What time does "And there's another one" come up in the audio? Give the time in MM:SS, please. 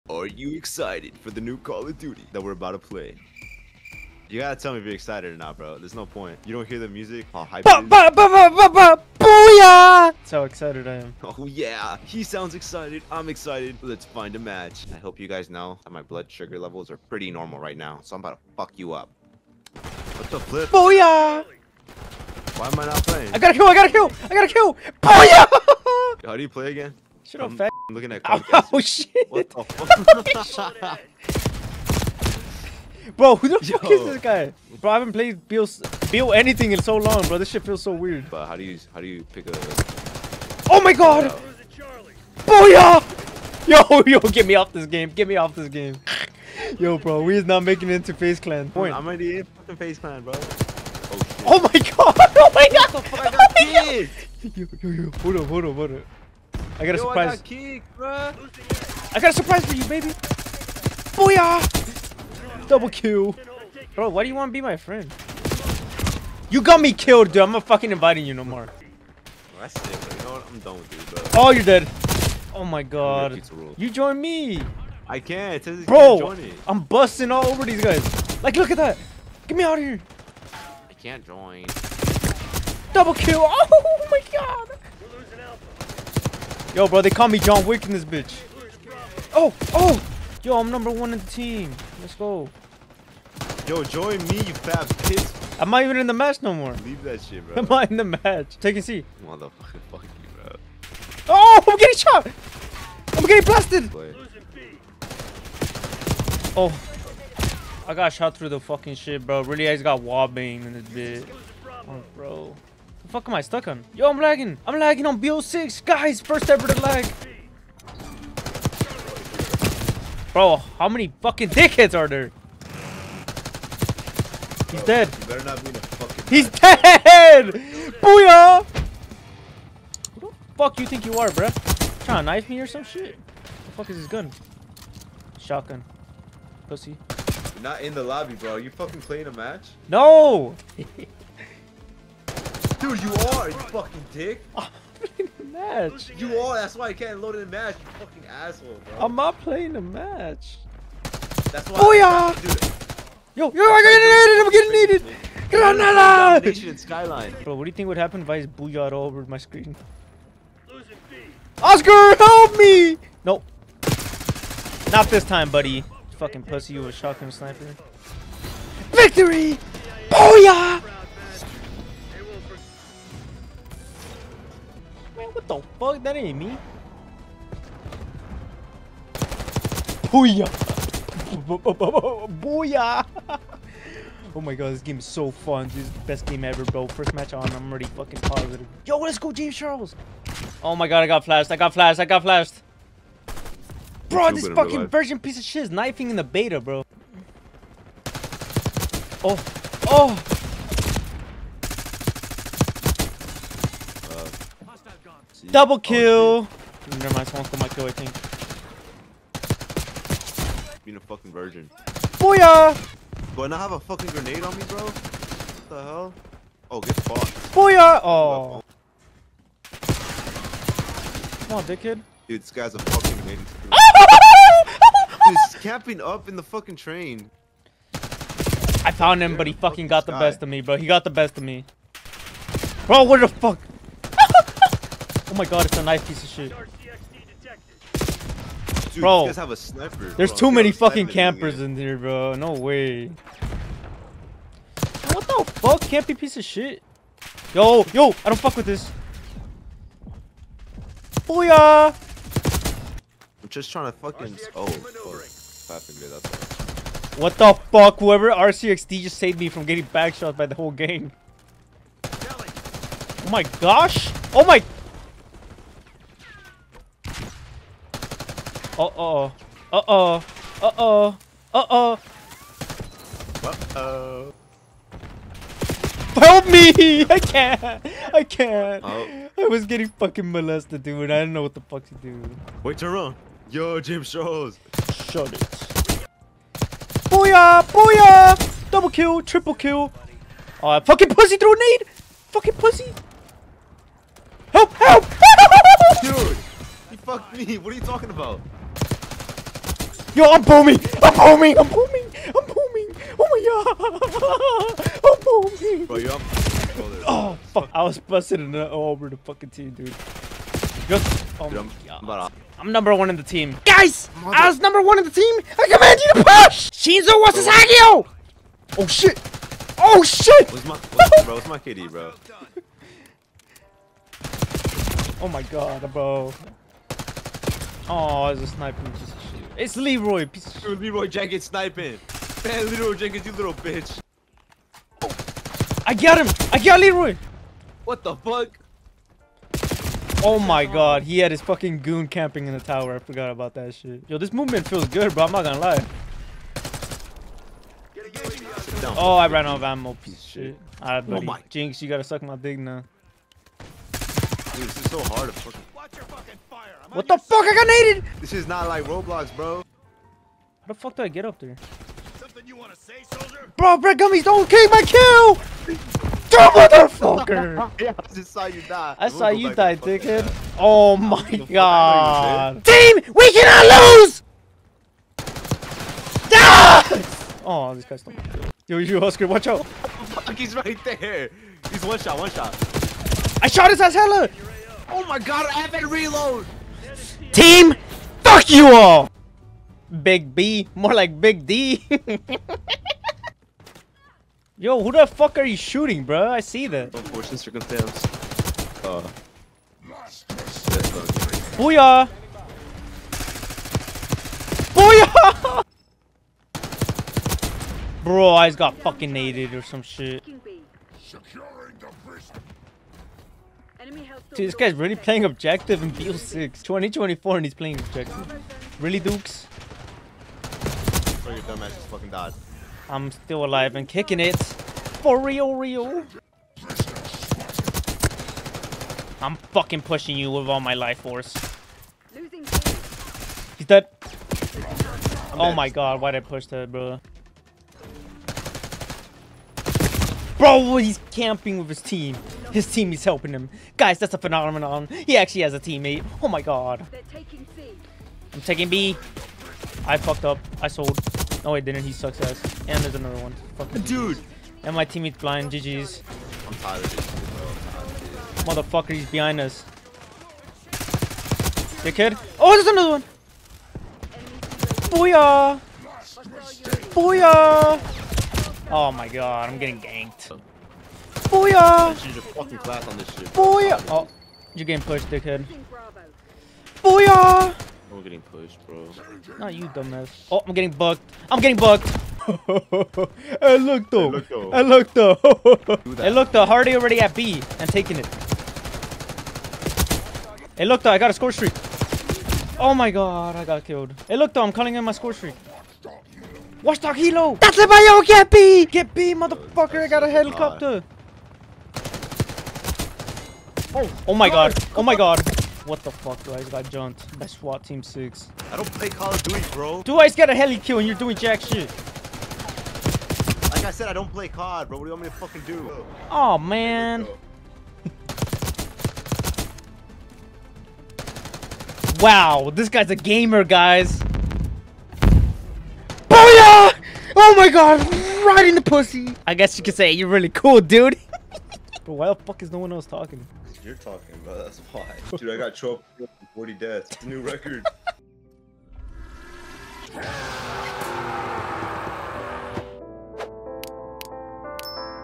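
07:32.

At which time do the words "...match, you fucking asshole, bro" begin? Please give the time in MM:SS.
02:27.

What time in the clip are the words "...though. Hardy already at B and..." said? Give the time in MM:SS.
08:06.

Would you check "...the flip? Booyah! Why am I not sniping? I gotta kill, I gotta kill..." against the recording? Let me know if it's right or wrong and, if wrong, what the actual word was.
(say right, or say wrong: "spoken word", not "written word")
wrong: "playing", not "sniping".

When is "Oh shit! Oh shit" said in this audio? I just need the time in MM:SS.
05:18.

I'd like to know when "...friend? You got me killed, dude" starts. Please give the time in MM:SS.
01:04.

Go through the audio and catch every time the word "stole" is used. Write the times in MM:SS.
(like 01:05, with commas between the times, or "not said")
03:27.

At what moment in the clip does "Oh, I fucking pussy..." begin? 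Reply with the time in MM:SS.
04:50.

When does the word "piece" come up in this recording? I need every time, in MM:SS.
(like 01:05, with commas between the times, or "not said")
03:15, 03:56, 04:06, 05:50.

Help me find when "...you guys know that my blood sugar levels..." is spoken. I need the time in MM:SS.
00:15.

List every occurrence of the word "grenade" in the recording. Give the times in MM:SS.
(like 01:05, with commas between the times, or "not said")
03:34, 03:43.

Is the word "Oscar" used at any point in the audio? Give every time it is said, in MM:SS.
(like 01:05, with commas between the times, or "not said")
02:41, 06:19.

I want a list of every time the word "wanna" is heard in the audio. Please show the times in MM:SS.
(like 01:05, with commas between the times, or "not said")
06:02.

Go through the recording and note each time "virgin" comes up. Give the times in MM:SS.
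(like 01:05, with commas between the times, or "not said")
03:14, 03:31.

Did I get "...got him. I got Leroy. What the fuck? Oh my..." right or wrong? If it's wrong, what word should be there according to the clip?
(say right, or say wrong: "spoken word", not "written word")
right.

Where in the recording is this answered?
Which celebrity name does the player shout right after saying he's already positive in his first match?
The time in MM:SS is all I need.
03:09.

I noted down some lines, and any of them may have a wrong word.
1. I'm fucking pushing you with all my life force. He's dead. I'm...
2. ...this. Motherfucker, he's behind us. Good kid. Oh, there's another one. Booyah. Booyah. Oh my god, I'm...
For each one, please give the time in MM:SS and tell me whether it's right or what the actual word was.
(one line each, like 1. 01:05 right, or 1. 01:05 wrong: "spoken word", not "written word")
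1. 07:09 right
2. 07:36 right.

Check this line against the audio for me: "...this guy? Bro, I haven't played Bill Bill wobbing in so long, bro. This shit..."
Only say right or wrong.
wrong.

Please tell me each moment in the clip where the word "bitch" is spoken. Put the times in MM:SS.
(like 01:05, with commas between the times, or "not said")
01:28, 01:51, 05:33.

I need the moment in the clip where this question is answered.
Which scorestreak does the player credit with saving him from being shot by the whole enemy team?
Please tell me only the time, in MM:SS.
04:18.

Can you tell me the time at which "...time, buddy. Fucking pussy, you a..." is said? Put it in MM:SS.
02:45.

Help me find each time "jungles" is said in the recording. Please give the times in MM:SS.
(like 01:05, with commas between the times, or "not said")
not said.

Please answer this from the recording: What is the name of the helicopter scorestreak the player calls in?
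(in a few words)
Watchdog Helo.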